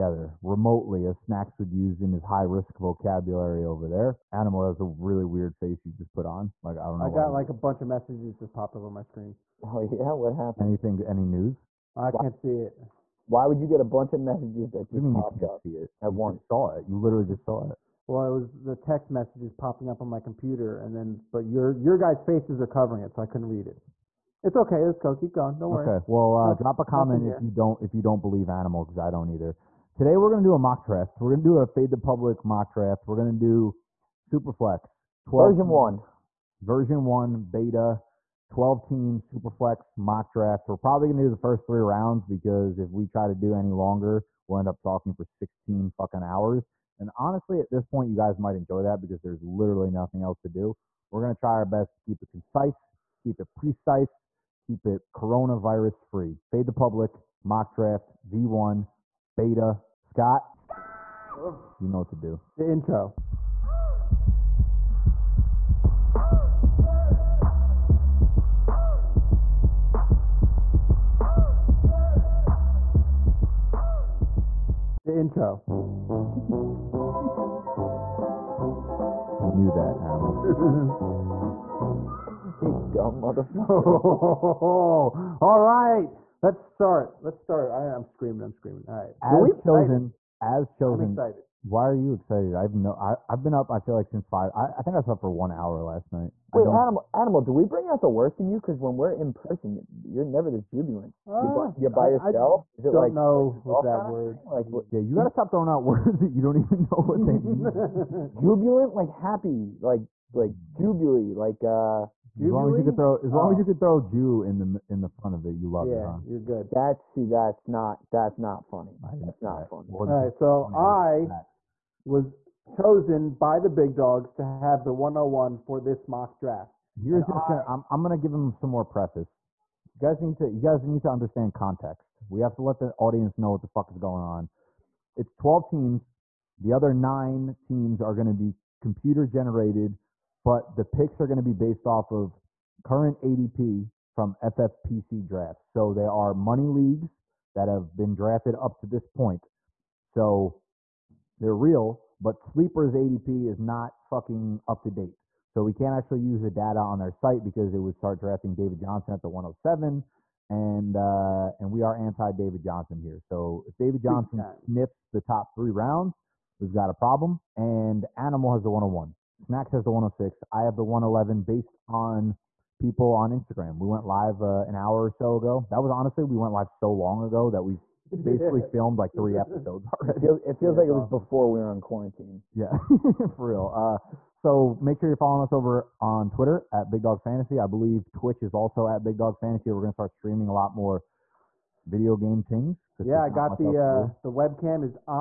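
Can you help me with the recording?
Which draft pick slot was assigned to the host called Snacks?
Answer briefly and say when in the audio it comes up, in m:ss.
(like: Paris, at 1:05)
106, at 2:49.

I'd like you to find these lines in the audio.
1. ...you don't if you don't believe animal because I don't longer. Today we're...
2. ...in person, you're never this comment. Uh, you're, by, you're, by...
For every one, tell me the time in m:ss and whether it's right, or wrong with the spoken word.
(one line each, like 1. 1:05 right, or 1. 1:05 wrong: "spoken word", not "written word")
1. 0:27 wrong: "either", not "longer"
2. 1:39 wrong: "jubilant", not "comment".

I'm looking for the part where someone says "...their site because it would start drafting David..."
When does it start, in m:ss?
2:36.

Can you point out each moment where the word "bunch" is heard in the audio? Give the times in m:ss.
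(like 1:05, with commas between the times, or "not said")
0:07, 0:13.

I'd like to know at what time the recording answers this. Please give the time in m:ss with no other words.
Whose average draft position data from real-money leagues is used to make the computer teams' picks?
2:24.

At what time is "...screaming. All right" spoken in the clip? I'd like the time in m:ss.
1:28.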